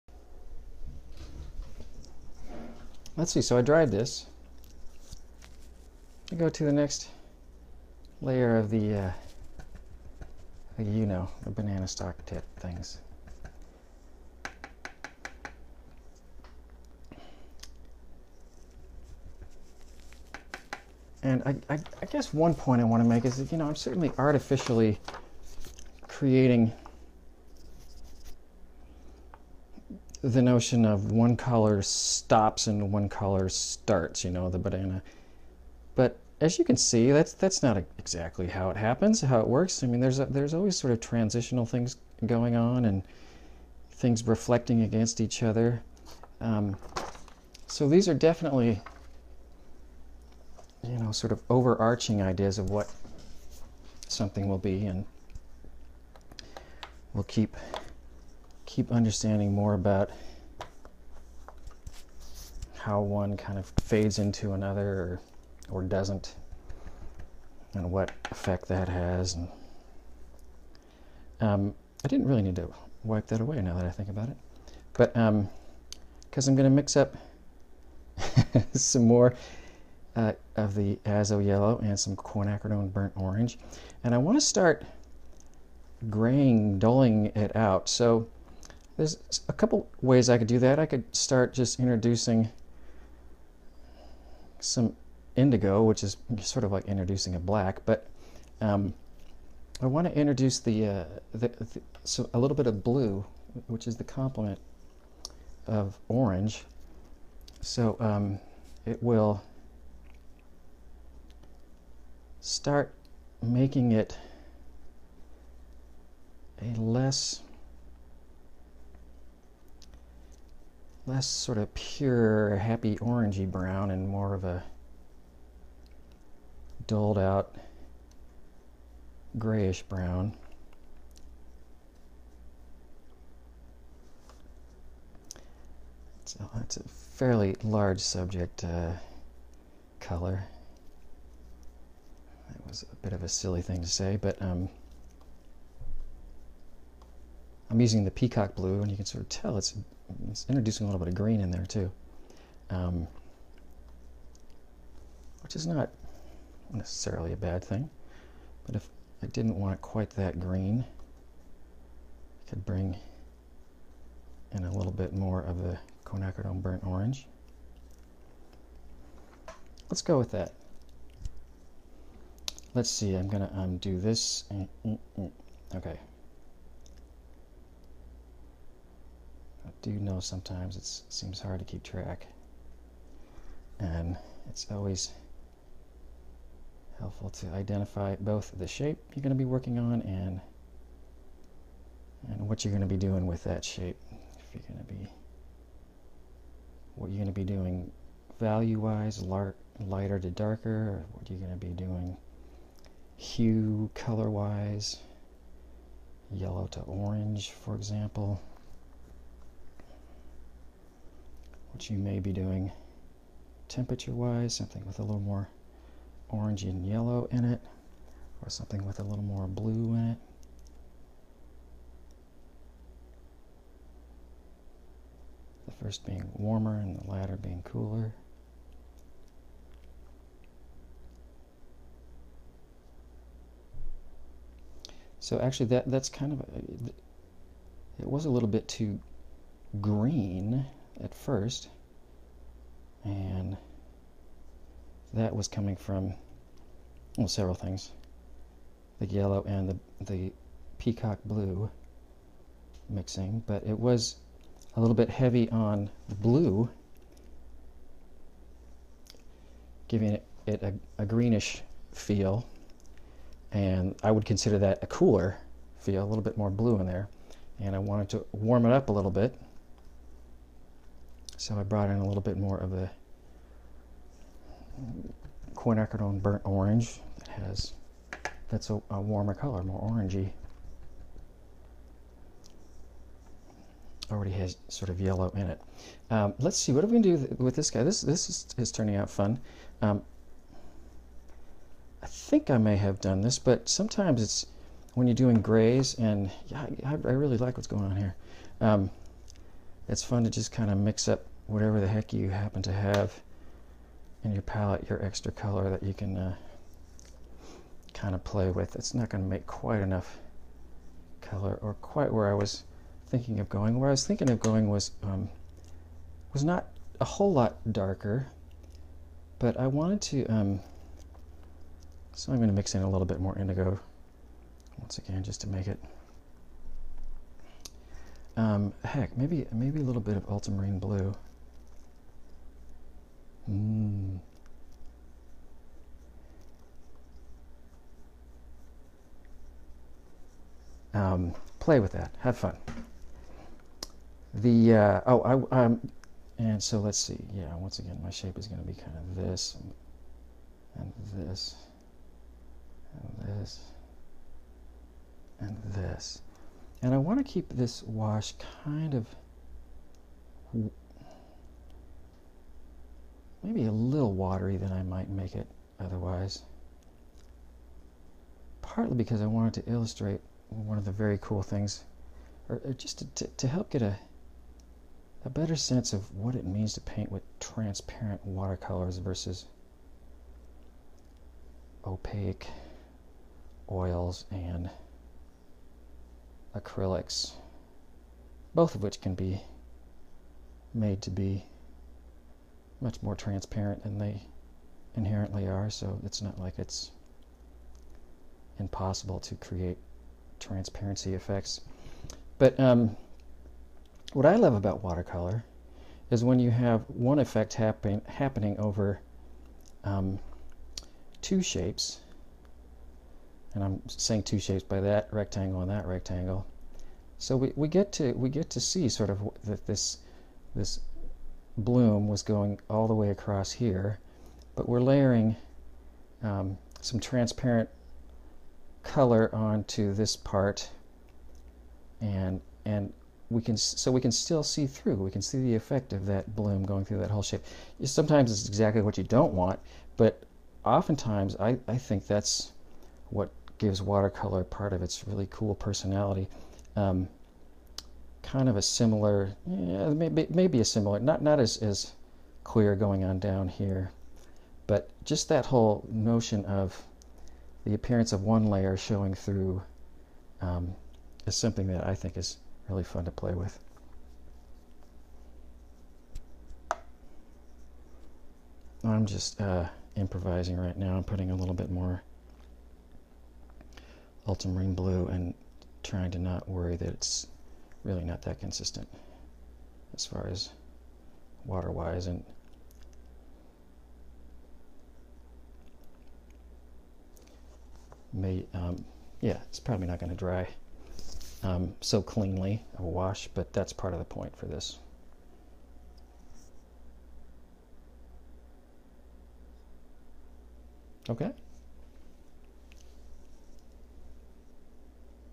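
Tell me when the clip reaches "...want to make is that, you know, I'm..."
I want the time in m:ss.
0:22.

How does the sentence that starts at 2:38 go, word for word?
But if I didn't want it quite that green, I could bring in a little bit more of the quinacridone burnt orange.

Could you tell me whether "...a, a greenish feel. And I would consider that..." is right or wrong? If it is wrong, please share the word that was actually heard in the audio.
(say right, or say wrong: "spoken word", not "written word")
right.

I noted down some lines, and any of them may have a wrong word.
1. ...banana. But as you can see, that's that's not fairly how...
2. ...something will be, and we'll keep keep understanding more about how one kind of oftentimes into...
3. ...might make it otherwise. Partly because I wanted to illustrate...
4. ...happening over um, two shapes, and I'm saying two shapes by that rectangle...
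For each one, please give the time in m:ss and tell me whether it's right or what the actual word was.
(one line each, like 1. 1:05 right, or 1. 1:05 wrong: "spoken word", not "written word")
1. 0:34 wrong: "exactly", not "fairly"
2. 0:54 wrong: "fades", not "oftentimes"
3. 6:04 right
4. 6:48 right.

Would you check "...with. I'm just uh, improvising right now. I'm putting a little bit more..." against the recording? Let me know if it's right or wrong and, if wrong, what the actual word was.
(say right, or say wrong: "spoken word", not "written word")
right.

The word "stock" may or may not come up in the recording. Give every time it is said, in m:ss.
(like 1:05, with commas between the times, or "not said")
0:11.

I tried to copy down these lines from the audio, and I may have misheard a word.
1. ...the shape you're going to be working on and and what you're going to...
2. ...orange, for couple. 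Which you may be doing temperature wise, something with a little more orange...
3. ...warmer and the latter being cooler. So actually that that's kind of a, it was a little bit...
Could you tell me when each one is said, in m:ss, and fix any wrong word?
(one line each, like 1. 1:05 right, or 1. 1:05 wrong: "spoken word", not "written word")
1. 3:08 right
2. 3:26 wrong: "example", not "couple"
3. 3:46 right.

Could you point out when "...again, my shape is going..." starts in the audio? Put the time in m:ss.
5:47.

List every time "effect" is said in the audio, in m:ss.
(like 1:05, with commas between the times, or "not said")
1:08, 6:41, 6:47, 7:15.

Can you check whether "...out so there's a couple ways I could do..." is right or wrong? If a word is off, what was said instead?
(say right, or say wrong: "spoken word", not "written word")
right.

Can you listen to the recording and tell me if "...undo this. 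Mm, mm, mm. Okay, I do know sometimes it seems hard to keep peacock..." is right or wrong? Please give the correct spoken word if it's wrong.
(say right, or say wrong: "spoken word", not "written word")
wrong: "track", not "peacock".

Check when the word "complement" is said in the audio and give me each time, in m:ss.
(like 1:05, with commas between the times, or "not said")
1:44.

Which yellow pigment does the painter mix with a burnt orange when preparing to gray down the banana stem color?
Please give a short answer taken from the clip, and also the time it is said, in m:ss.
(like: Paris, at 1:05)
azo yellow, at 1:21.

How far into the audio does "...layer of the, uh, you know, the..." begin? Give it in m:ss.
0:08.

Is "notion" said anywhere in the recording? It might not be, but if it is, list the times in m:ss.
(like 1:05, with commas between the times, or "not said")
0:30, 7:35.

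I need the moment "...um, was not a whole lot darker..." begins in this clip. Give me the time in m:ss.
5:15.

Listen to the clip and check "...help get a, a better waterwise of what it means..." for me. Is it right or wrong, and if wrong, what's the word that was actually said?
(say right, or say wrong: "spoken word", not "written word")
wrong: "sense", not "waterwise".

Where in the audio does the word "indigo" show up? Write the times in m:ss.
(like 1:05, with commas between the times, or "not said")
1:35, 5:23.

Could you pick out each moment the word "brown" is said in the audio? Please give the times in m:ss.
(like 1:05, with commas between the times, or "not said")
2:03, 2:09.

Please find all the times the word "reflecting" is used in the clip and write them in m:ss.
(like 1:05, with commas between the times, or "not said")
0:44.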